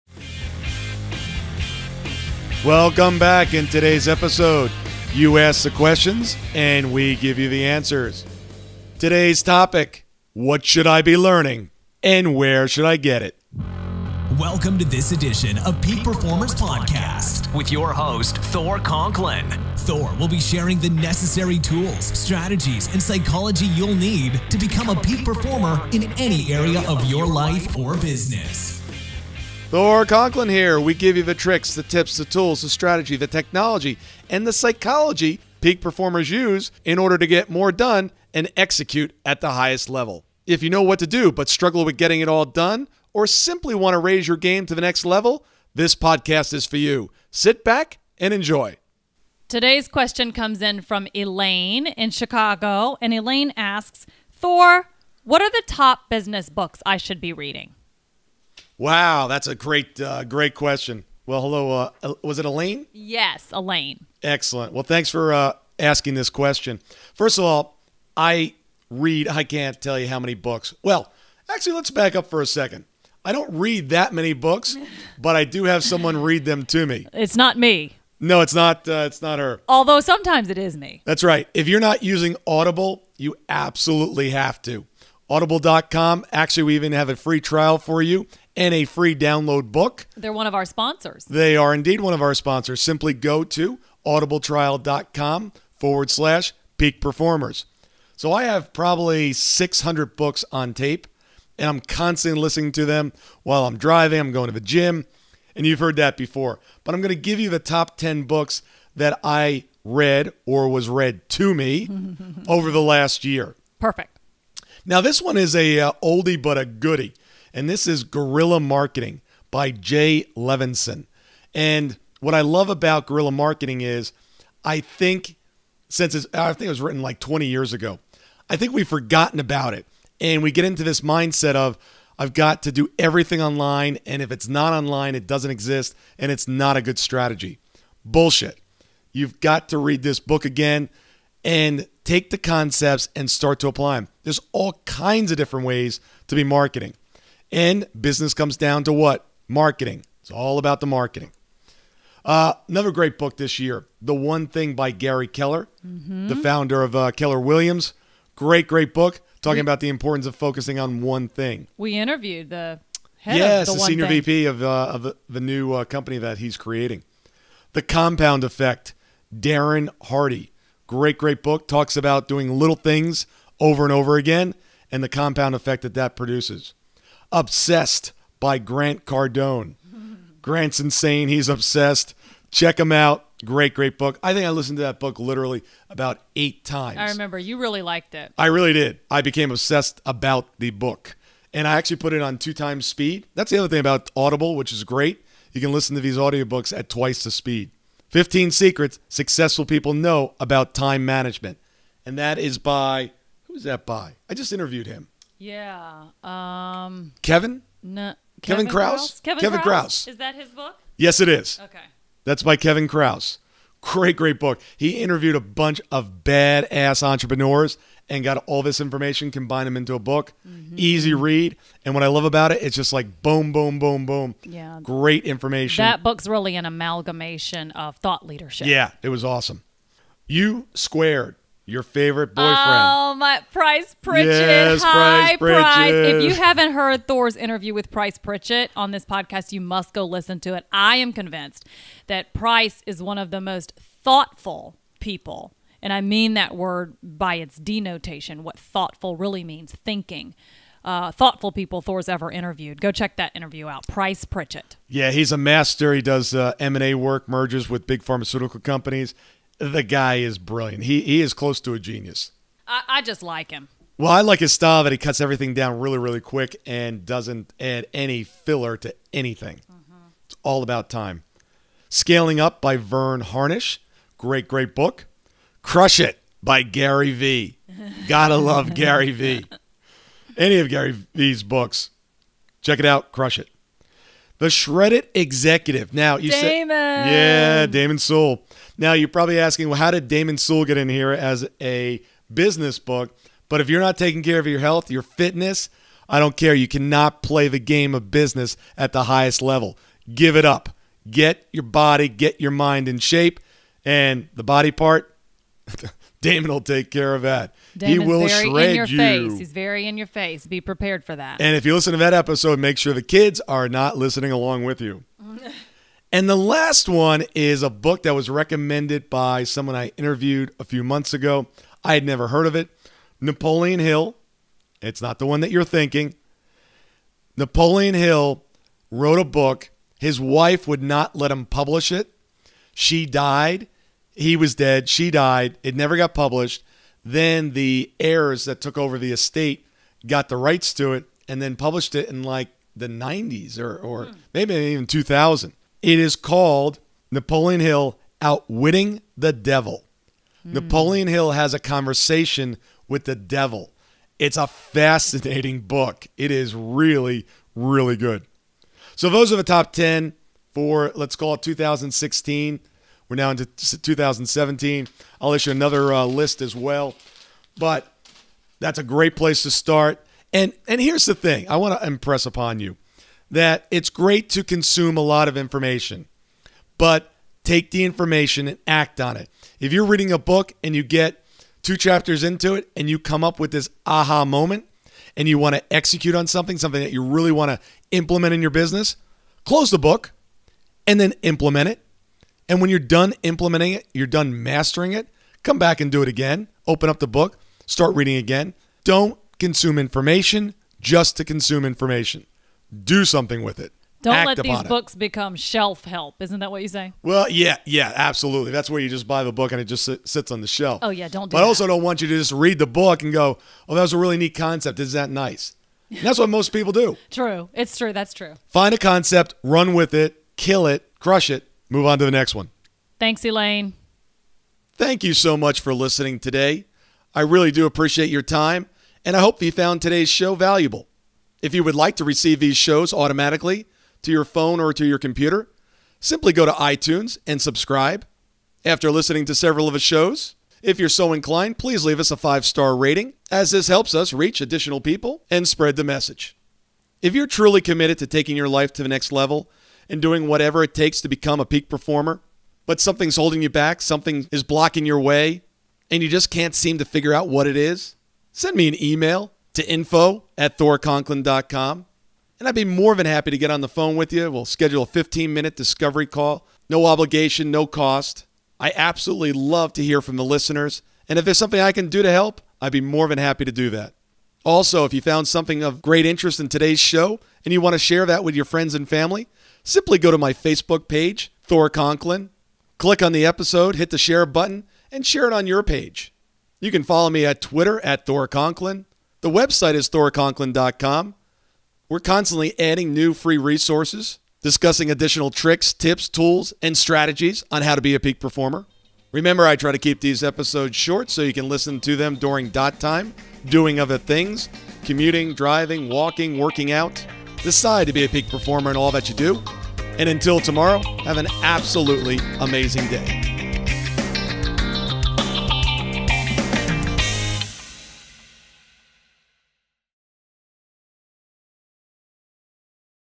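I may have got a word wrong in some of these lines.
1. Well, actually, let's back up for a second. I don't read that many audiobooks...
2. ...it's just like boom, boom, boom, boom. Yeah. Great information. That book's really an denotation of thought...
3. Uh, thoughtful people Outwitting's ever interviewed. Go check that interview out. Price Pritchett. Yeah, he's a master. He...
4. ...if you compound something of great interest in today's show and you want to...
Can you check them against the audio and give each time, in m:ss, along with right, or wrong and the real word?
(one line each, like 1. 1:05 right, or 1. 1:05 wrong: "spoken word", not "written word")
1. 1:10 wrong: "books", not "audiobooks"
2. 3:42 wrong: "amalgamation", not "denotation"
3. 4:10 wrong: "Thor", not "Outwitting"
4. 7:54 wrong: "found", not "compound".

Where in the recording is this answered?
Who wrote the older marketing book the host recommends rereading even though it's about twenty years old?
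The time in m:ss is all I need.
1:59.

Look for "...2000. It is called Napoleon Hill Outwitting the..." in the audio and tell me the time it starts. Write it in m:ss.
5:44.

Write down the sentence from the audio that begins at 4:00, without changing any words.
I am convinced that Price is one of the most thoughtful people.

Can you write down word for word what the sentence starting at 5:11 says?
And if you listen to that episode, make sure the kids are not listening along with you.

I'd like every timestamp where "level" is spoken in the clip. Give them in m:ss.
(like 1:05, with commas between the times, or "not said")
0:39, 0:45, 4:59, 7:29.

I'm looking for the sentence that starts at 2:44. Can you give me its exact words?
VP of, uh, of the, the new uh, company that he's creating.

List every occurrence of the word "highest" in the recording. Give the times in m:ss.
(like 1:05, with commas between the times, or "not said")
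0:39, 4:59.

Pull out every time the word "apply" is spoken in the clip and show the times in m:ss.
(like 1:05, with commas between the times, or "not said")
2:23.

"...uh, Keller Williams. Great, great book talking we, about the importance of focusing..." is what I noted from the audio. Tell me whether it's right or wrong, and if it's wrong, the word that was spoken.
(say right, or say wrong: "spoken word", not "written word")
right.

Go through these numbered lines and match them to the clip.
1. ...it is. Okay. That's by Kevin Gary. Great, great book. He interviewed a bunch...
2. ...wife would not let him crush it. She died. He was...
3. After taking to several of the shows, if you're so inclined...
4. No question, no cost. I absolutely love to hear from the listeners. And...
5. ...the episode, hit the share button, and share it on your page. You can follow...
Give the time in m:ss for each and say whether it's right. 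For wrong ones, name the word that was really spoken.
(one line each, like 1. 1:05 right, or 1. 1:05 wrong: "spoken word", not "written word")
1. 3:31 wrong: "Kruse", not "Gary"
2. 5:30 wrong: "publish", not "crush"
3. 7:18 wrong: "listening", not "taking"
4. 7:46 wrong: "obligation", not "question"
5. 8:03 right.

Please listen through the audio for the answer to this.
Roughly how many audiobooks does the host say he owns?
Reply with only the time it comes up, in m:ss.
1:39.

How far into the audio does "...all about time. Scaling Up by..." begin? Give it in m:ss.
4:30.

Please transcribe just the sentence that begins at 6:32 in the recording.
And when you're done implementing it, you're done mastering it, come back and do it again.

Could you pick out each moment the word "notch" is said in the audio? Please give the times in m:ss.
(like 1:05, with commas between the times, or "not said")
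not said.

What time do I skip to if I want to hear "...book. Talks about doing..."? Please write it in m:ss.
2:51.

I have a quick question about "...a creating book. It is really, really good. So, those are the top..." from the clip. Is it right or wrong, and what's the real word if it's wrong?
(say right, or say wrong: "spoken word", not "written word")
wrong: "fascinating", not "creating".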